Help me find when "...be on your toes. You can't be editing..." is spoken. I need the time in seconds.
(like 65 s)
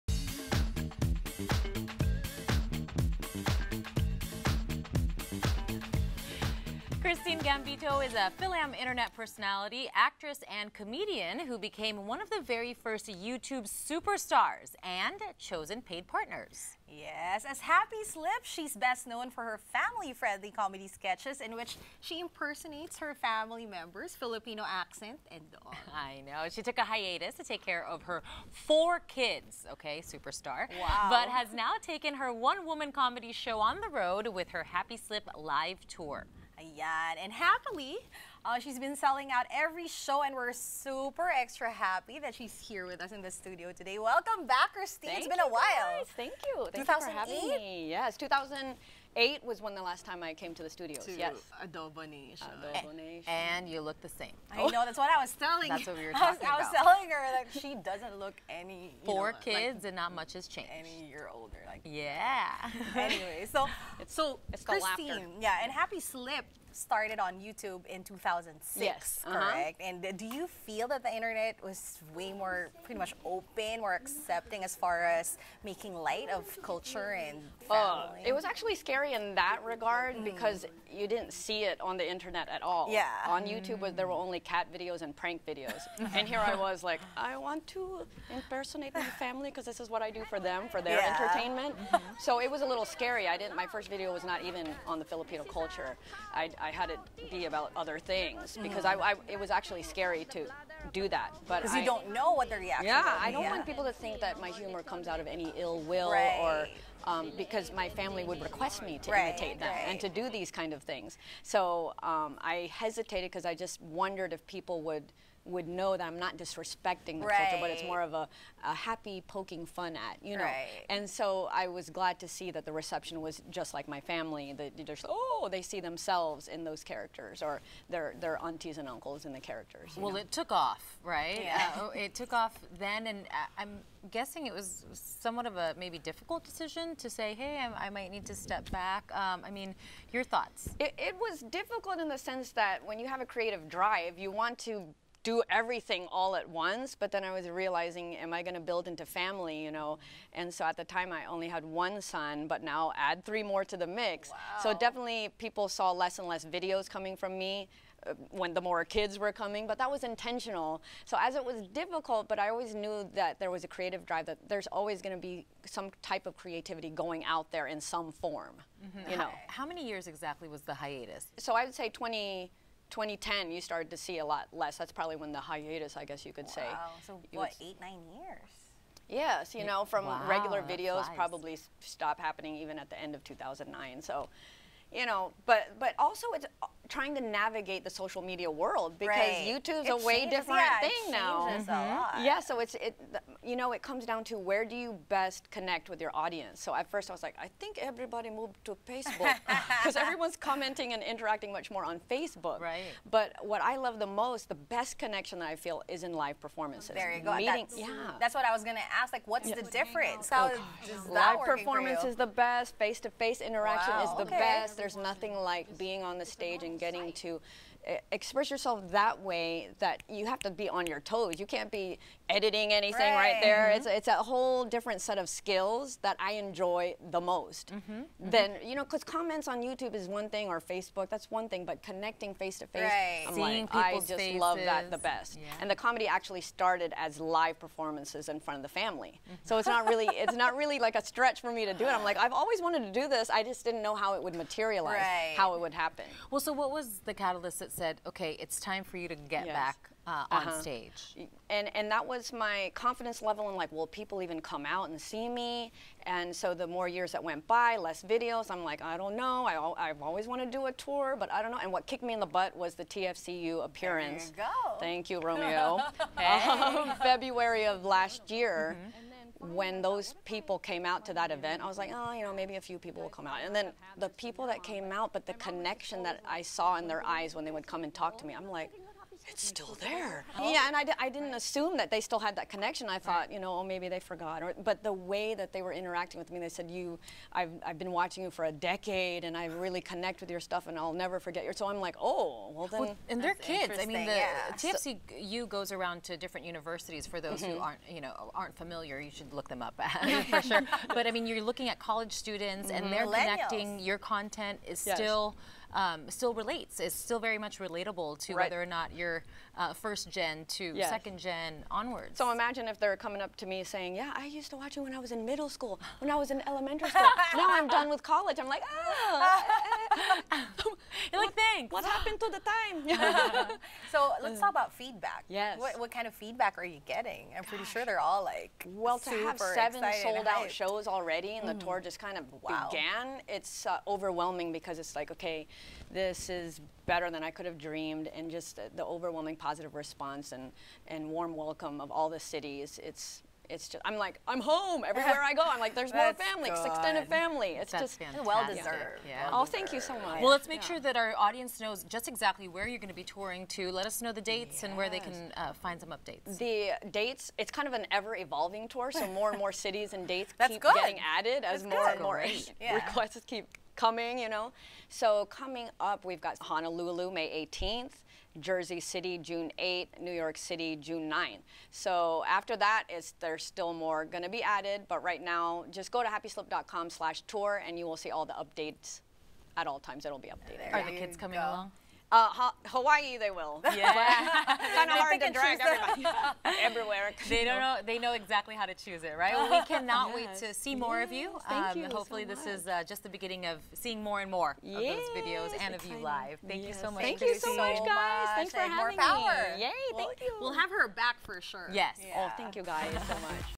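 220 s.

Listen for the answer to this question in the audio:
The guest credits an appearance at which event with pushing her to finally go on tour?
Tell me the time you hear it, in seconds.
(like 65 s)
262 s.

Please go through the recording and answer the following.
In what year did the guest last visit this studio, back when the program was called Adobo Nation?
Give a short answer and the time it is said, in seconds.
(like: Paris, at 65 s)
2008, at 48 s.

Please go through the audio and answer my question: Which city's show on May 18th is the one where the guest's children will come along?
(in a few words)
Honolulu.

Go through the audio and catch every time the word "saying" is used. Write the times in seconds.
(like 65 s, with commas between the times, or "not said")
313 s.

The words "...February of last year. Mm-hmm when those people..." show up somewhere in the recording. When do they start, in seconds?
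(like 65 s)
267 s.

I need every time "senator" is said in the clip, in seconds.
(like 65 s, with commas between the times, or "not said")
not said.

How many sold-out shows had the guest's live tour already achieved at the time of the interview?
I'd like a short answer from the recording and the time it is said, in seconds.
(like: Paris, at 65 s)
7, at 329 s.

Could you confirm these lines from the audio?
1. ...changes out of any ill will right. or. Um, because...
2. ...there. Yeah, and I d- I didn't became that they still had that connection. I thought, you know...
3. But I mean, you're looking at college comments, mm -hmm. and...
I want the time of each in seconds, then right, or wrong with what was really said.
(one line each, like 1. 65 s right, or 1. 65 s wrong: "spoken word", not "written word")
1. 104 s wrong: "comes", not "changes"
2. 279 s wrong: "assume", not "became"
3. 300 s wrong: "students", not "comments".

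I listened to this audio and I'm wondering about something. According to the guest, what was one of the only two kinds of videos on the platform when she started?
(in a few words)
Cat videos.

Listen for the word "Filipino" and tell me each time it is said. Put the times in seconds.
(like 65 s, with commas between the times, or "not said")
24 s, 95 s.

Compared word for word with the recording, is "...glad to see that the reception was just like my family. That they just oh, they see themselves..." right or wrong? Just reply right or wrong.
right.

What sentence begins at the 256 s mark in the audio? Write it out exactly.
And so the more years that went by, less videos.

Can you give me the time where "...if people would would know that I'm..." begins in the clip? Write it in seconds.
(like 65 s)
114 s.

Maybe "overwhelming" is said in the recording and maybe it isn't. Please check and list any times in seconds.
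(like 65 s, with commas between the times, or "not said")
333 s, 338 s.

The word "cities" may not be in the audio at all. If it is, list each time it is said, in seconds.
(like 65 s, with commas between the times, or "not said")
342 s, 359 s.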